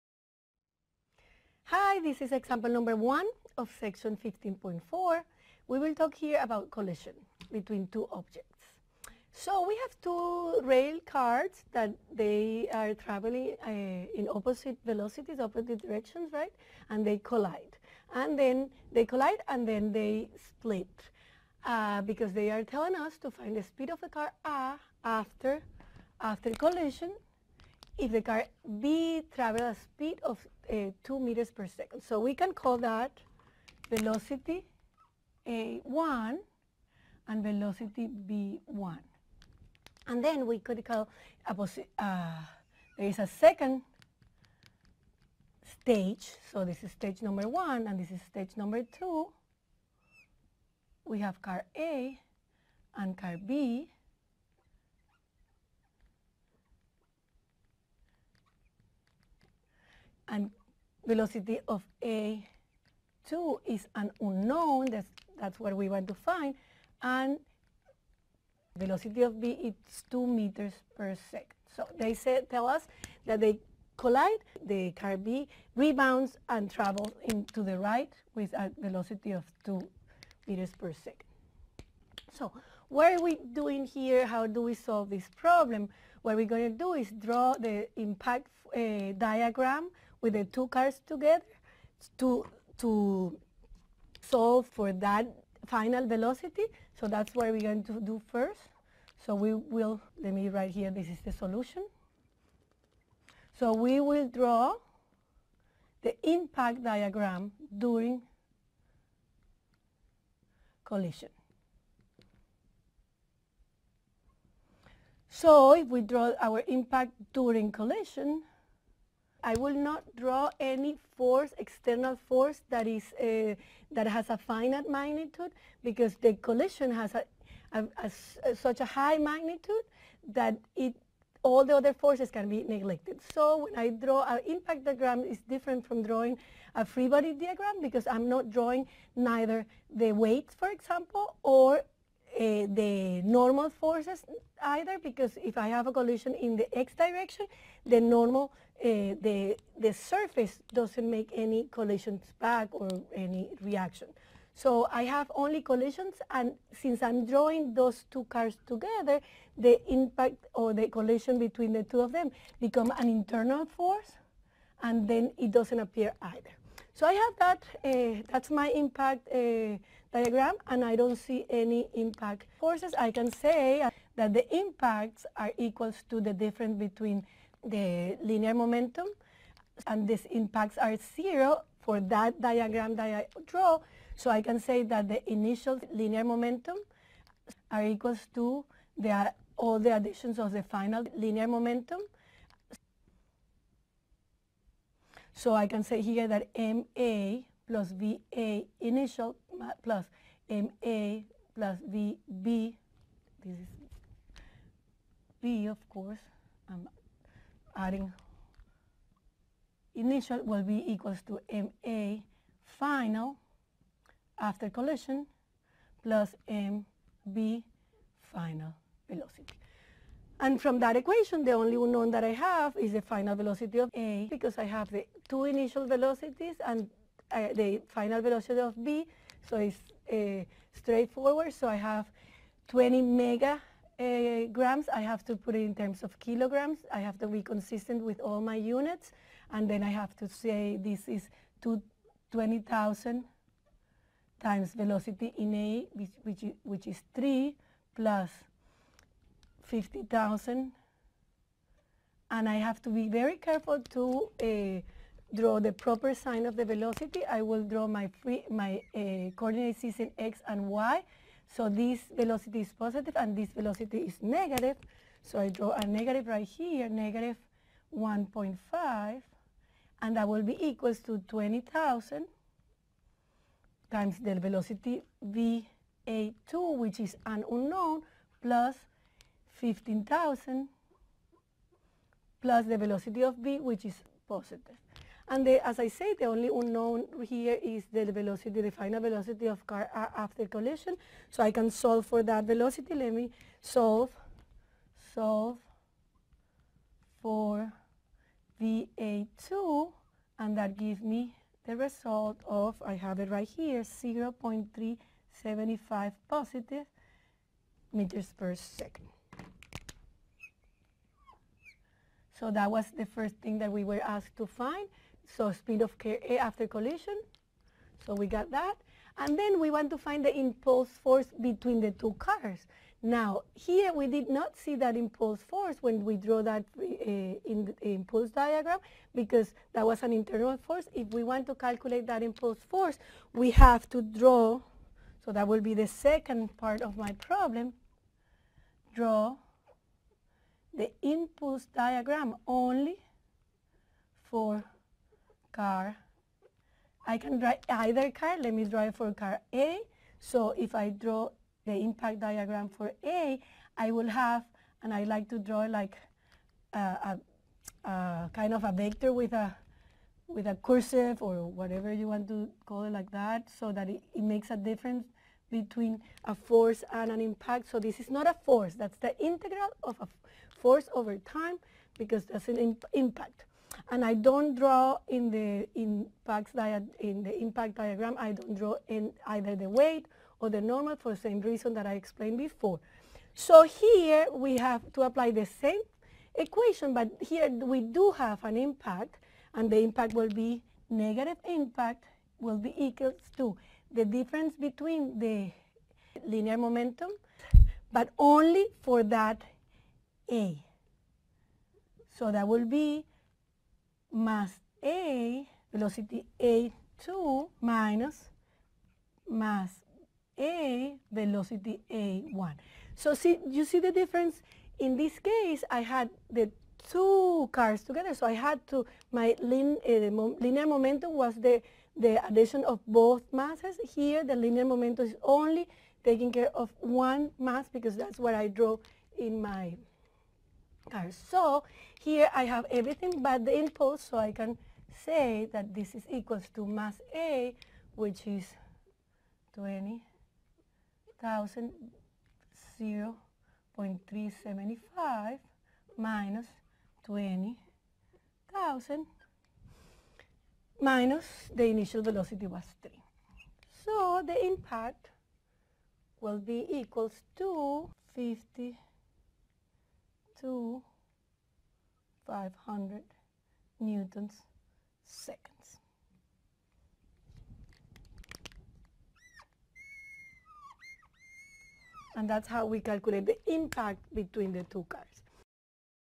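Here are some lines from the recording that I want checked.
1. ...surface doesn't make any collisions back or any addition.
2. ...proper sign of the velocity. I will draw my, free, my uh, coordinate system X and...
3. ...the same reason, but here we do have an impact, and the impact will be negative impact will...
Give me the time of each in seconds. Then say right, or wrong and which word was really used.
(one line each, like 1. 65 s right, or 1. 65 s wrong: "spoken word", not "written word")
1. 149 s wrong: "reaction", not "addition"
2. 255 s right
3. 385 s wrong: "equation", not "reason".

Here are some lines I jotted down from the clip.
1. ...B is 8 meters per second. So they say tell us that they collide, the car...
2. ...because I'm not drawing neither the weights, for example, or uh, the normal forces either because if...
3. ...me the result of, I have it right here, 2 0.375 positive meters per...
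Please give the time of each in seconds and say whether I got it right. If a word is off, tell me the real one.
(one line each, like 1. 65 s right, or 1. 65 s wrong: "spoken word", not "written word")
1. 69 s wrong: "2", not "8"
2. 137 s right
3. 301 s wrong: "0", not "2".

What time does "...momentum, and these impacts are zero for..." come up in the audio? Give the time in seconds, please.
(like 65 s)
178 s.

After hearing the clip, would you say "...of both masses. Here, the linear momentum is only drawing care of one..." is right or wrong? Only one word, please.
wrong.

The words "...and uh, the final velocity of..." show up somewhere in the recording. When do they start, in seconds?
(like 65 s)
226 s.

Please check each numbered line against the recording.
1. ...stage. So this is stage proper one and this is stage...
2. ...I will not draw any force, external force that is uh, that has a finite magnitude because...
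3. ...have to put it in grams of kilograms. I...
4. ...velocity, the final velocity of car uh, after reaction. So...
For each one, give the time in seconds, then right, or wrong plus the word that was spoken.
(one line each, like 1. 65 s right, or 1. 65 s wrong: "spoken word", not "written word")
1. 45 s wrong: "number", not "proper"
2. 119 s right
3. 235 s wrong: "terms", not "grams"
4. 288 s wrong: "collision", not "reaction".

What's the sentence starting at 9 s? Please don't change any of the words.
So we have two rail cars that they are traveling uh, in opposite velocities, opposite directions, right?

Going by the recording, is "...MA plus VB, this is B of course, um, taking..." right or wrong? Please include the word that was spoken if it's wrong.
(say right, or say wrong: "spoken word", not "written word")
wrong: "adding", not "taking".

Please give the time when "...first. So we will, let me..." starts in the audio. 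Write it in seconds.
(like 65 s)
98 s.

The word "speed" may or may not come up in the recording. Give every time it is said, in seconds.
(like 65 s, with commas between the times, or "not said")
23 s, 29 s, 315 s.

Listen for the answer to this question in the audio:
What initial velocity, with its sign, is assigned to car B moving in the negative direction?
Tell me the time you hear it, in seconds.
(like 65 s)
266 s.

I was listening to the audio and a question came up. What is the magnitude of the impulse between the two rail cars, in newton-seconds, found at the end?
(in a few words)
500 N·s.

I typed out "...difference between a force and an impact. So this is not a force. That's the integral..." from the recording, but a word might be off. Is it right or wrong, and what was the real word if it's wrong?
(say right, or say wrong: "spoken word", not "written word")
right.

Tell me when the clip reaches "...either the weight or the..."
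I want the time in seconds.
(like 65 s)
379 s.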